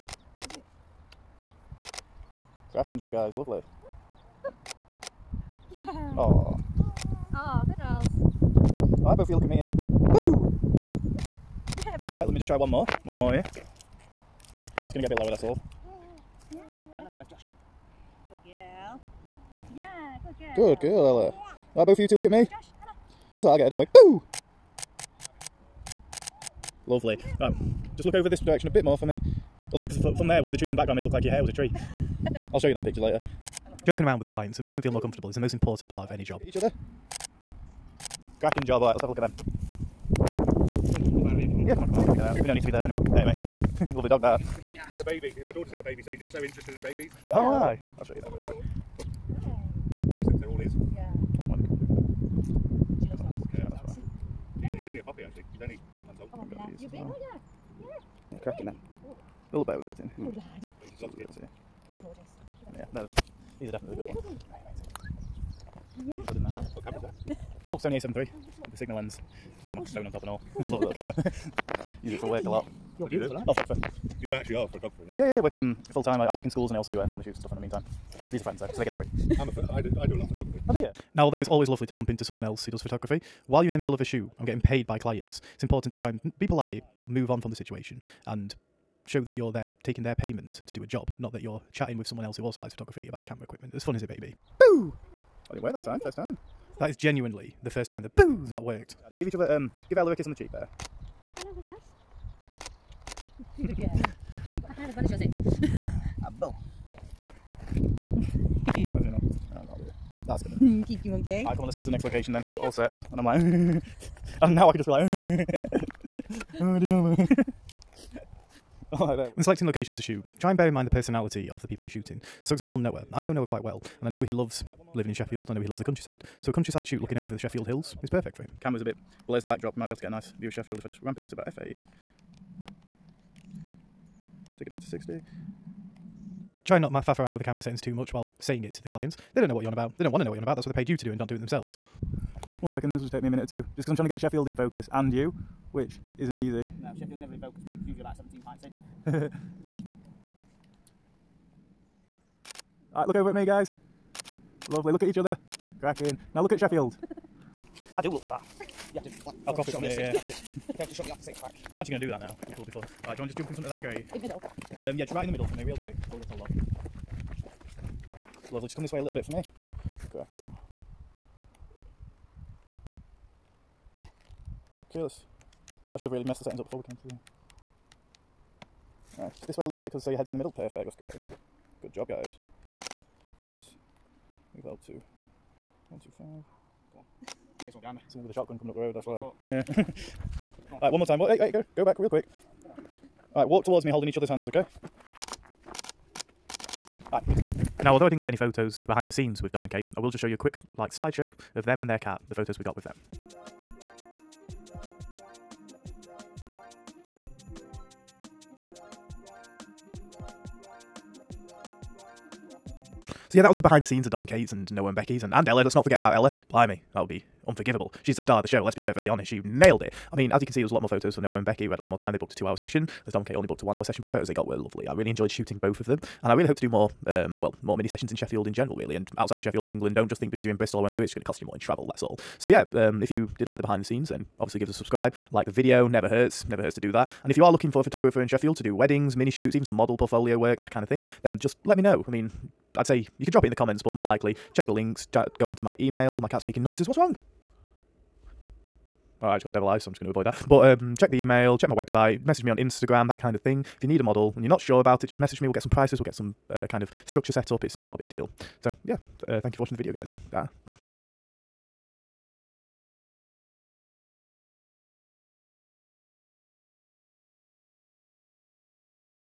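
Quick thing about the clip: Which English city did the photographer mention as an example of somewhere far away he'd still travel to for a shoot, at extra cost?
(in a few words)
Bristol.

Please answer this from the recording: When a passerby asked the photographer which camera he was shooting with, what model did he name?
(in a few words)
Sony A7 III.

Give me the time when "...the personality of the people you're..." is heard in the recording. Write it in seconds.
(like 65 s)
120 s.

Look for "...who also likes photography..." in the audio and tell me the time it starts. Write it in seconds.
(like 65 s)
92 s.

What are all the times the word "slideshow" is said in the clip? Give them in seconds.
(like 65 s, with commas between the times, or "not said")
200 s.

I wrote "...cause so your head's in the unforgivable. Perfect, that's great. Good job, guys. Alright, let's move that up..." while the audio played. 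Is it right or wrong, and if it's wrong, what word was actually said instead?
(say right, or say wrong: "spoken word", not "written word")
wrong: "middle", not "unforgivable".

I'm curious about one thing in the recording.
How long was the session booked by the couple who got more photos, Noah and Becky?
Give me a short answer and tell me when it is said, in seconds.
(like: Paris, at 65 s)
2 hours, at 222 s.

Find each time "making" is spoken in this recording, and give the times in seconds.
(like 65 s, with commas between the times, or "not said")
34 s, 246 s.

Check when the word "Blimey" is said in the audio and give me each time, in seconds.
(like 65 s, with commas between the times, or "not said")
216 s.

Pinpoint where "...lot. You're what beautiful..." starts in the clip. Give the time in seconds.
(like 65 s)
72 s.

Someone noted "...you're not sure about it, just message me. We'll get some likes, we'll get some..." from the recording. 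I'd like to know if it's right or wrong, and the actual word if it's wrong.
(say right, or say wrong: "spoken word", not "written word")
wrong: "prices", not "likes".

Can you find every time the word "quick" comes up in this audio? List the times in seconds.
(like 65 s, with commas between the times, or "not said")
165 s, 192 s, 200 s.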